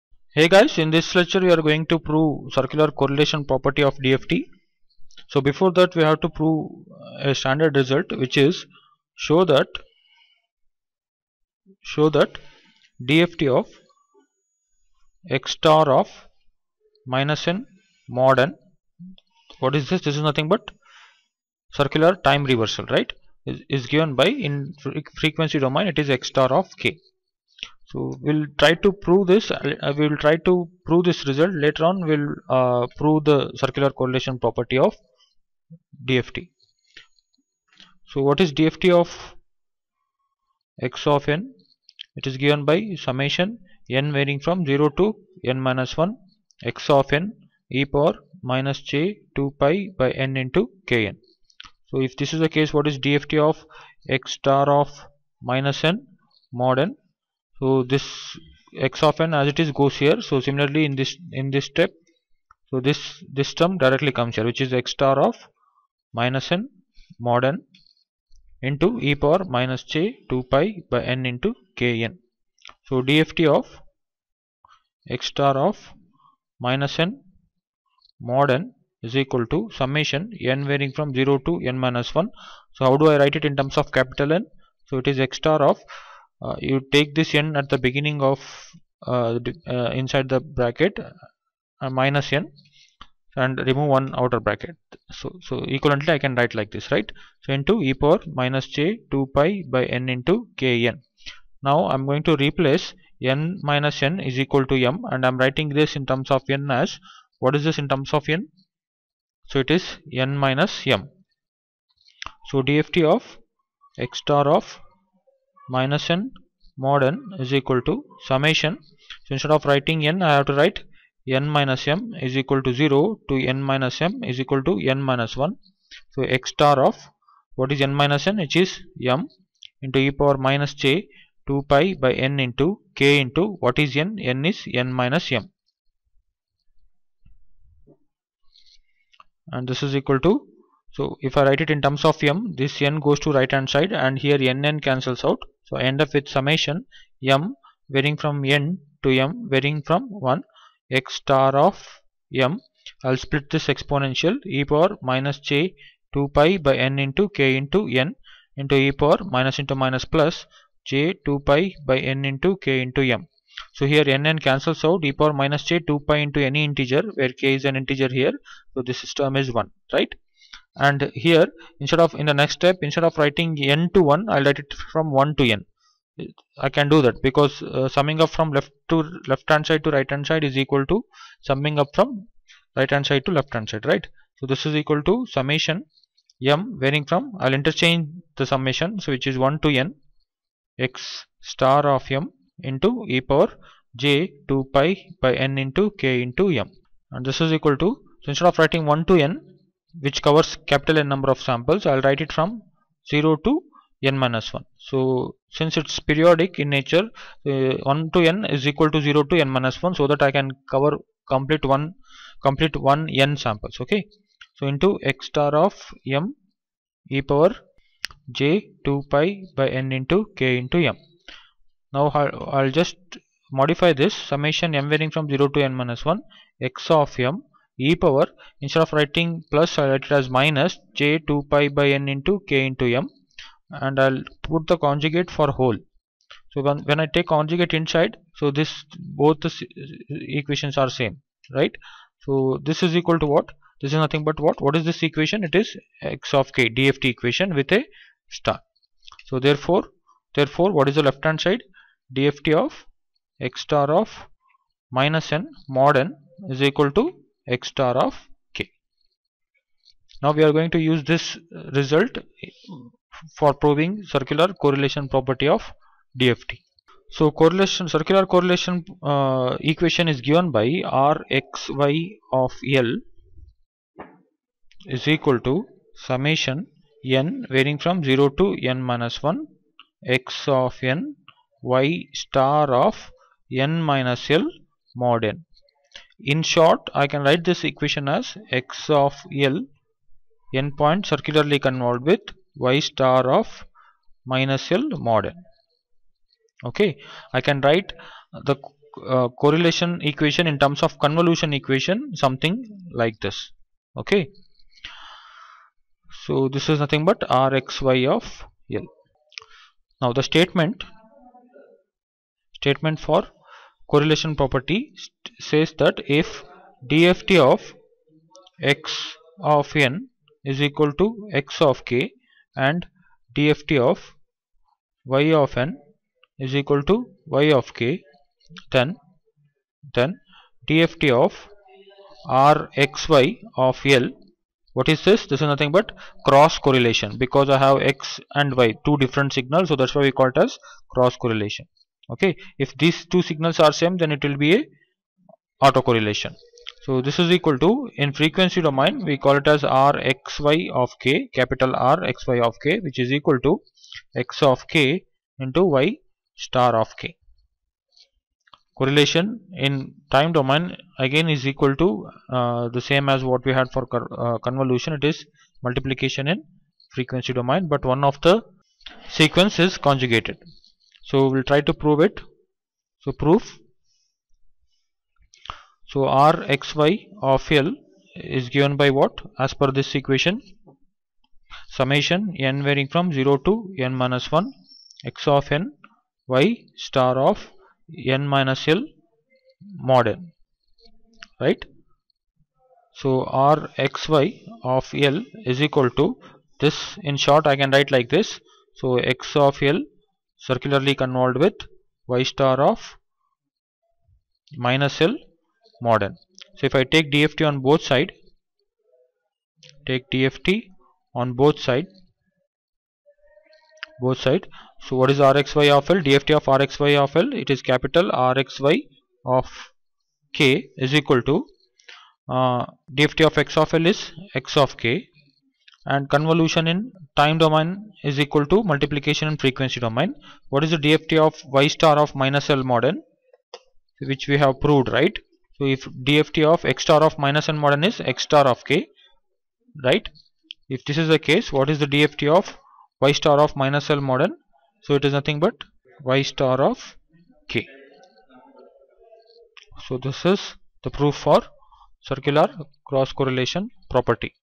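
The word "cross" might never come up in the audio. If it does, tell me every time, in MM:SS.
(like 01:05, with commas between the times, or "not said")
05:36, 05:40, 07:32.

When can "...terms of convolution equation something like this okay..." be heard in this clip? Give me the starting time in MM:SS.
05:00.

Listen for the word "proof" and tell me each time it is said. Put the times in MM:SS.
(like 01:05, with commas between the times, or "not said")
06:13, 07:30.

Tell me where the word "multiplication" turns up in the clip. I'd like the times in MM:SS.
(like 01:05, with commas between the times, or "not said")
06:05, 07:08.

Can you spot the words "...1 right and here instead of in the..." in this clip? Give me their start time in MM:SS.
02:49.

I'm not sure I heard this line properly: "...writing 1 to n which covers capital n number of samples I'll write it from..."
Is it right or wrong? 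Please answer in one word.
right.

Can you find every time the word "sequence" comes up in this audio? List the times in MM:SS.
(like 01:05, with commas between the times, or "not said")
06:09.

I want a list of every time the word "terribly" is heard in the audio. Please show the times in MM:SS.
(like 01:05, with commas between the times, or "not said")
not said.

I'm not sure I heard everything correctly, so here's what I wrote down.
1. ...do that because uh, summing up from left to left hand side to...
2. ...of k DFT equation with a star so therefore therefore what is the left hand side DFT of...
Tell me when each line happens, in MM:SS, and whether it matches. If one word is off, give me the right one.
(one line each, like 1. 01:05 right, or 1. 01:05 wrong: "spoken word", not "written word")
1. 02:56 right
2. 04:06 right.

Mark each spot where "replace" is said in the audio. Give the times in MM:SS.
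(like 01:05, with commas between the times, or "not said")
01:42.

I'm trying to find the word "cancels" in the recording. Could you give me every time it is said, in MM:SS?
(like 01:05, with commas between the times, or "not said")
02:24, 02:44.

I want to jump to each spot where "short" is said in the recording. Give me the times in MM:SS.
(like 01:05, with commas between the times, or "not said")
04:46, 06:37.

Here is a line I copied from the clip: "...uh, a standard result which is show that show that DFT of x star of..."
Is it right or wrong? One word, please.
right.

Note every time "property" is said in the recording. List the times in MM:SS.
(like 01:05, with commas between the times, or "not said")
00:03, 00:34, 04:25, 05:14, 07:33.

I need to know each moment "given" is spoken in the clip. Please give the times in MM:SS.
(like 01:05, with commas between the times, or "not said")
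00:23, 00:42, 04:30, 06:18.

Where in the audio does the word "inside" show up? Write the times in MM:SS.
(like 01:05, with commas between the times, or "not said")
01:30, 03:57.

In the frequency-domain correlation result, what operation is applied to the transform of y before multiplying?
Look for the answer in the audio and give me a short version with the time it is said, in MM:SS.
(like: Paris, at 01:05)
conjugated, at 06:09.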